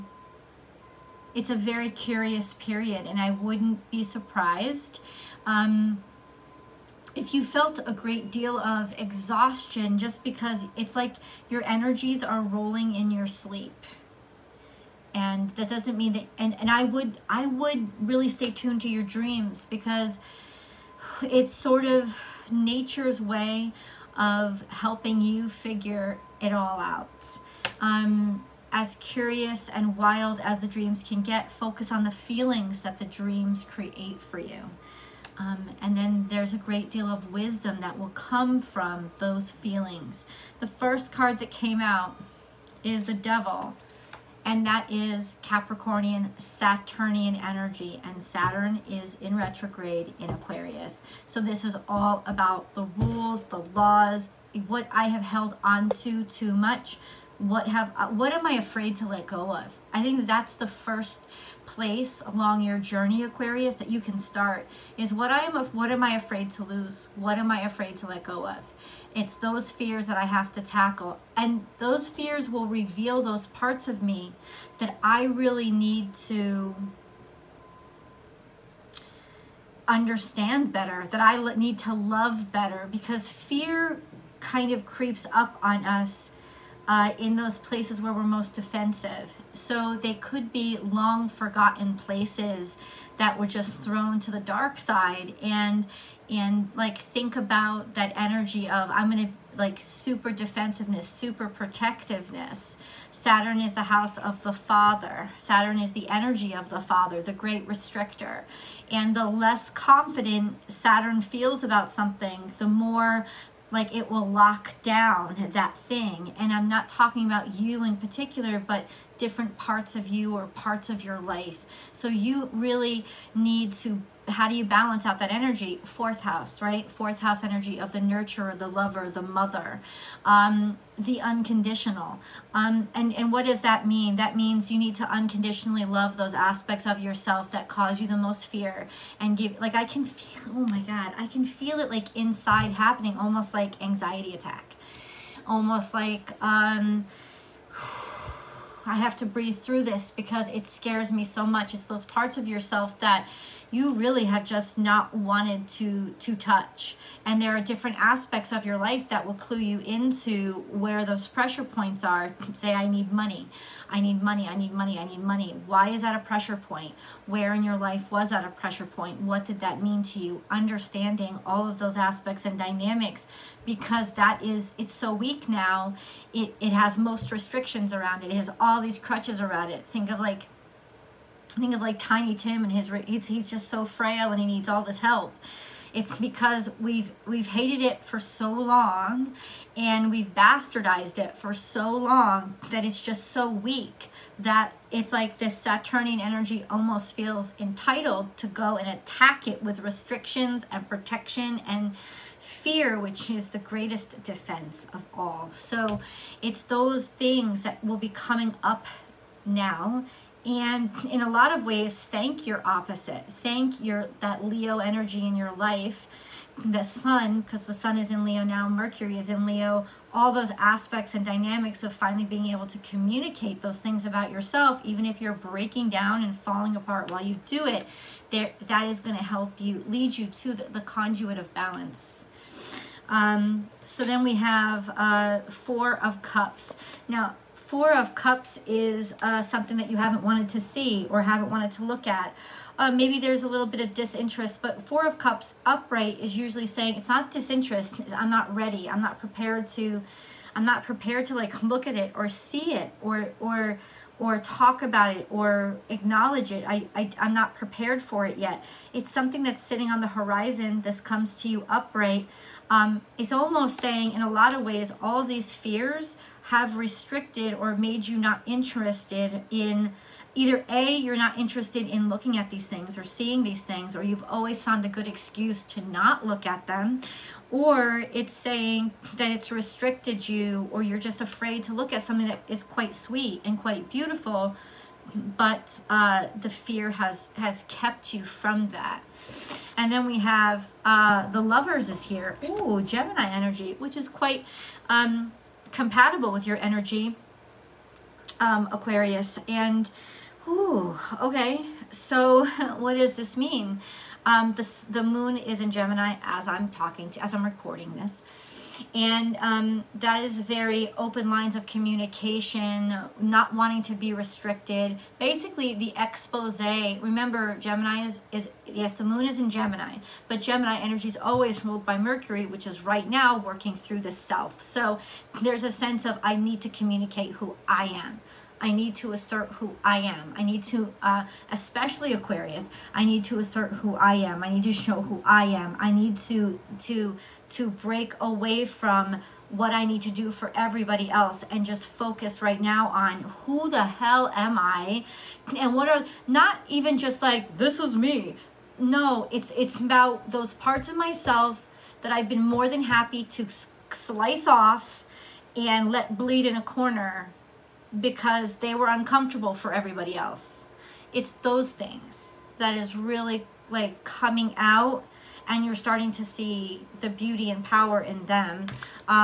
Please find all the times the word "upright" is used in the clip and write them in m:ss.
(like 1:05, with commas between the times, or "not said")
4:05, 4:21.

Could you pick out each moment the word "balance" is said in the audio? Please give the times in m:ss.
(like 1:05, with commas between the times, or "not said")
2:04, 3:51.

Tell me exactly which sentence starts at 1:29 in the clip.
So they could be long forgotten places that were just mm-hmm.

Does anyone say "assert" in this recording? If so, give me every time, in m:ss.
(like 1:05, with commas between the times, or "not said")
5:29, 5:33.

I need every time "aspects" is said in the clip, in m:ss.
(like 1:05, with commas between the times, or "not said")
2:16, 2:37, 2:51, 3:40.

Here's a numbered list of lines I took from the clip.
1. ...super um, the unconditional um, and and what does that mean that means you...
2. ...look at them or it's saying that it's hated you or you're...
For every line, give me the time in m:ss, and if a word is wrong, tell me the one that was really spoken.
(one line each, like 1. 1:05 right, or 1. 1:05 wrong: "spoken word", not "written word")
1. 2:09 wrong: "mother", not "super"
2. 4:36 wrong: "restricted", not "hated".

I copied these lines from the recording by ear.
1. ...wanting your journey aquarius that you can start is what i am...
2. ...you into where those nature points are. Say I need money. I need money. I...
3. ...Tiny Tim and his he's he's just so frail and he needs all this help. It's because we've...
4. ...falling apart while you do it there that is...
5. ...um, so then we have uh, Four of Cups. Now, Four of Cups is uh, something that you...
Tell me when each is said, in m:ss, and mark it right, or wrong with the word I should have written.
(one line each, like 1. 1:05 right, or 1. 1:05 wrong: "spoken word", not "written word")
1. 1:02 wrong: "along", not "wanting"
2. 2:39 wrong: "pressure", not "nature"
3. 3:01 right
4. 3:46 right
5. 3:53 right.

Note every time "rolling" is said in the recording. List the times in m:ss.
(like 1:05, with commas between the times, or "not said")
0:12.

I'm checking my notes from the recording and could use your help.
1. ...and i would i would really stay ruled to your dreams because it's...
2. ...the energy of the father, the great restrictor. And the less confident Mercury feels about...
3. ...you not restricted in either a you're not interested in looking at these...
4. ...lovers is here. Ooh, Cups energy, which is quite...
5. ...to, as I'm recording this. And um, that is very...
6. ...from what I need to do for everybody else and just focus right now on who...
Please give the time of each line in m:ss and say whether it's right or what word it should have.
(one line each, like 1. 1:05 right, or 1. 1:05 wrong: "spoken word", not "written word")
1. 0:16 wrong: "tuned", not "ruled"
2. 1:45 wrong: "Saturn", not "Mercury"
3. 4:28 wrong: "interested", not "restricted"
4. 4:51 wrong: "Gemini", not "Cups"
5. 5:07 right
6. 5:38 right.